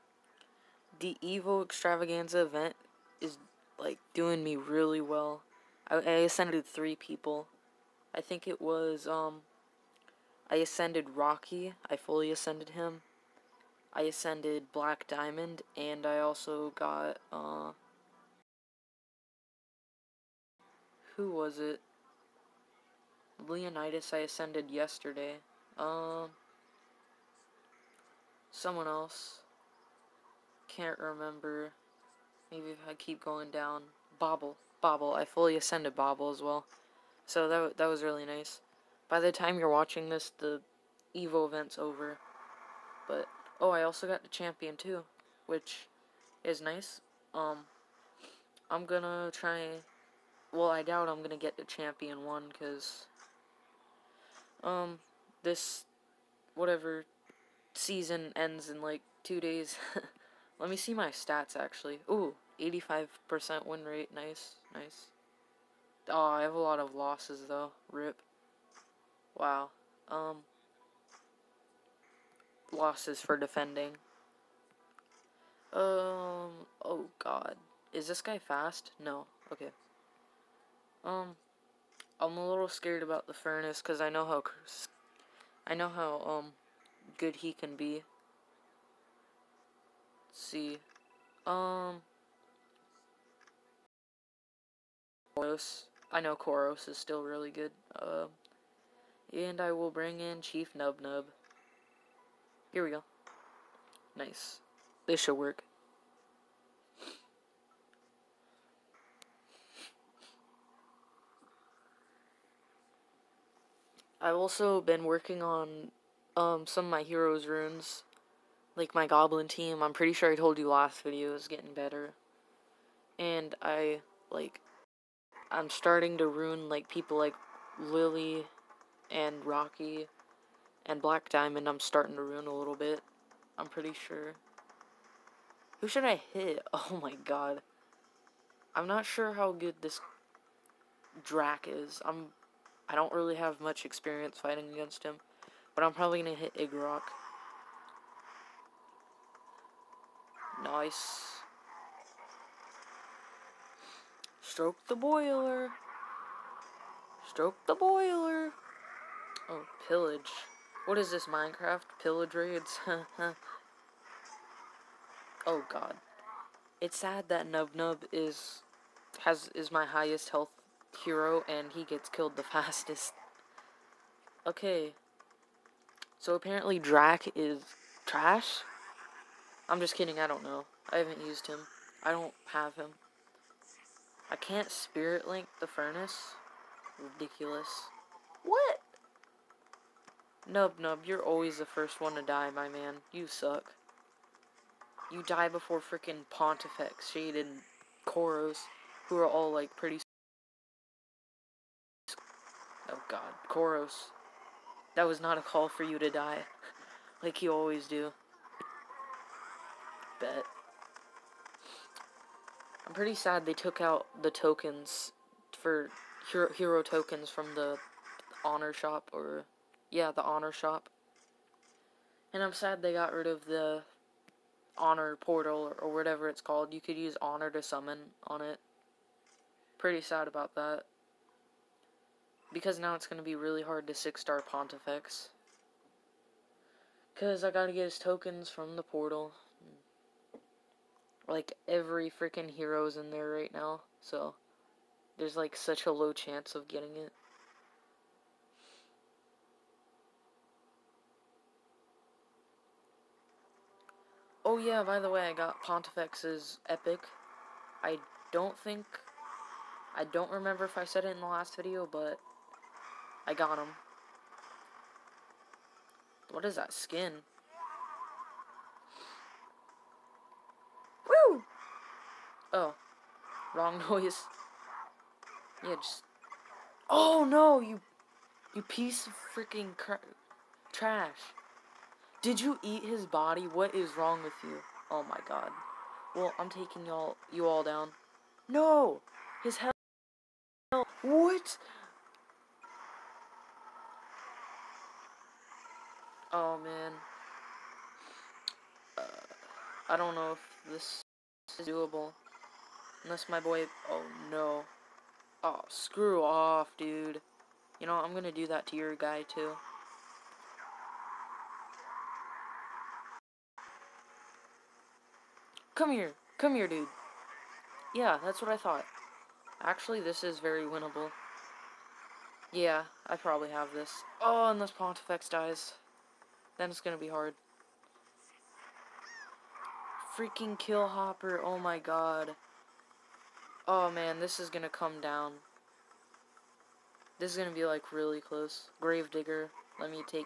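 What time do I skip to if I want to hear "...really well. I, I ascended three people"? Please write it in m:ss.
0:04.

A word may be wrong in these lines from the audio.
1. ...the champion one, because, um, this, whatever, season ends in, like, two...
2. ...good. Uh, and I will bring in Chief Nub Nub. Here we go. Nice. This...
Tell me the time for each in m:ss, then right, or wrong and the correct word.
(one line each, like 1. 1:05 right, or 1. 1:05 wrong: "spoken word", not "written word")
1. 0:51 right
2. 1:37 right.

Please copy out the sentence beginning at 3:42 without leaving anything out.
And I'm sad they got rid of the honor portal or, or whatever it's called.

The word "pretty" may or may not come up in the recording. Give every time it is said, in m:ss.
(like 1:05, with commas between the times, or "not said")
1:59, 2:13, 3:19, 3:32, 3:49.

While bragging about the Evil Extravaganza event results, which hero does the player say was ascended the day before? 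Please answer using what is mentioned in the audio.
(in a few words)
Leonidas.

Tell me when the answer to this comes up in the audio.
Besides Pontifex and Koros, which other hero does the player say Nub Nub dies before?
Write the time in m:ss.
3:17.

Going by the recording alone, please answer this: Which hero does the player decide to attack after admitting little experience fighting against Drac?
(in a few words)
Igrok.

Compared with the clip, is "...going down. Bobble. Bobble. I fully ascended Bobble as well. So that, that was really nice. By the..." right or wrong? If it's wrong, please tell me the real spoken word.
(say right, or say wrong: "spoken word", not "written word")
right.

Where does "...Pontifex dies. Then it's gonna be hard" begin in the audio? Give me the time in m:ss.
5:24.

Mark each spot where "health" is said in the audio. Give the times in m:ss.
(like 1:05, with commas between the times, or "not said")
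2:50, 4:49.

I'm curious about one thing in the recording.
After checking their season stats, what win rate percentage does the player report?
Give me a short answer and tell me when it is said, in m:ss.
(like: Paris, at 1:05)
85%, at 1:02.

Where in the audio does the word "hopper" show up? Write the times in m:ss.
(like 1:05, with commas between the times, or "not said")
5:30.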